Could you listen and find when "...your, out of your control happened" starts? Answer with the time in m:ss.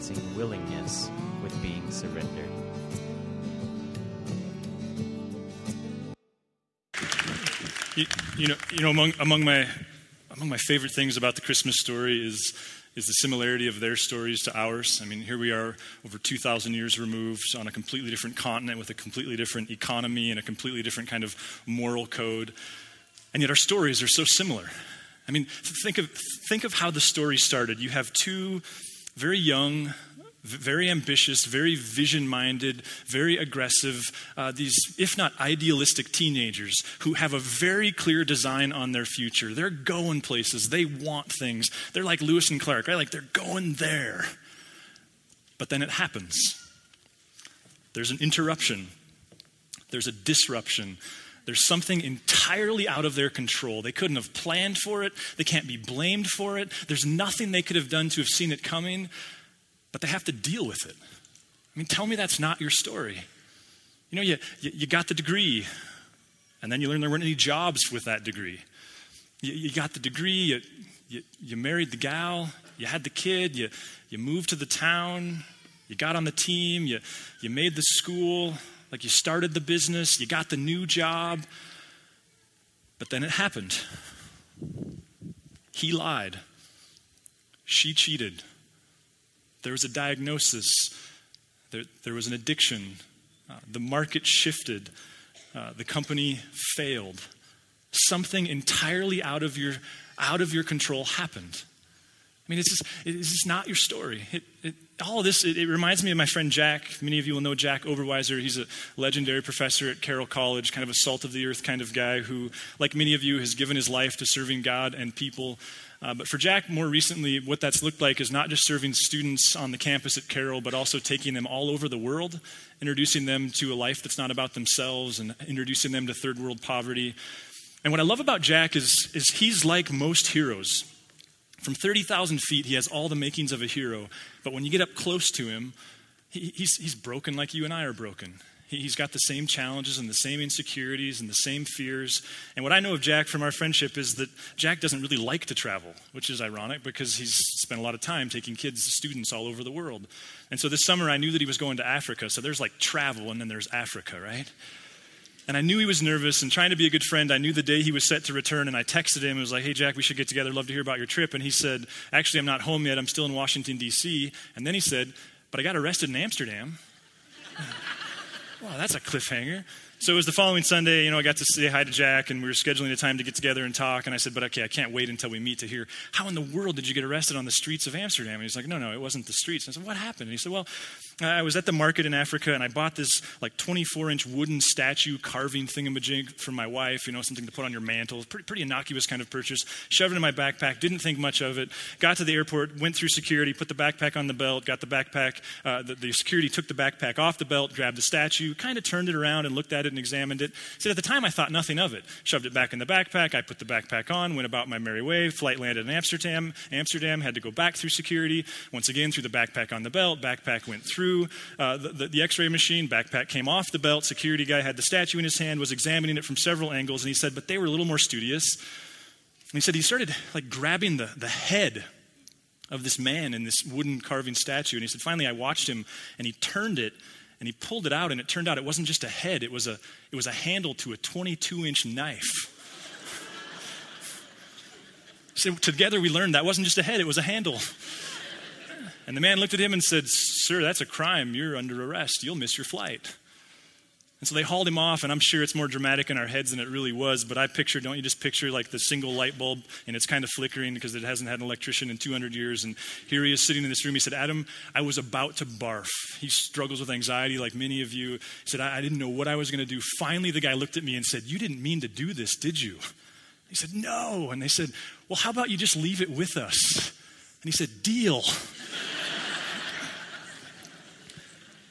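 1:39.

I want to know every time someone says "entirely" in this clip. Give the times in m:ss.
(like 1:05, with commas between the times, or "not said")
0:52, 1:38.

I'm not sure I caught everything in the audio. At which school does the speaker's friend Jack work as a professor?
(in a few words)
Carroll College.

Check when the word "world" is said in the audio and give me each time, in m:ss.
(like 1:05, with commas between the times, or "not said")
2:01, 2:06, 2:29, 2:56.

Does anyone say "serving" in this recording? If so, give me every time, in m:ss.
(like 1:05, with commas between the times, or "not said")
1:54, 1:58.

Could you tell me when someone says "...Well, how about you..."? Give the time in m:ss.
4:25.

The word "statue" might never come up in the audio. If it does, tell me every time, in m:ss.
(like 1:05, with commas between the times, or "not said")
3:04, 3:18, 3:34, 3:44.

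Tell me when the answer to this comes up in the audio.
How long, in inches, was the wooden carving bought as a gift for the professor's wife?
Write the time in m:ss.
3:03.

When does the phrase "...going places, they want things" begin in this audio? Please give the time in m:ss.
0:39.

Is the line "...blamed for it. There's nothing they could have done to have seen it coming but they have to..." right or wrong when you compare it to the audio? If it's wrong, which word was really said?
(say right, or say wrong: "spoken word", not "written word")
right.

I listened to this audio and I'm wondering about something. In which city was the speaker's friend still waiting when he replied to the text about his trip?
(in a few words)
Washington, D.C.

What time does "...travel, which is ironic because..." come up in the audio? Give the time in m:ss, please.
2:25.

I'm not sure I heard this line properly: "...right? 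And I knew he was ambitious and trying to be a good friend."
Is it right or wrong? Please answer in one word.
wrong.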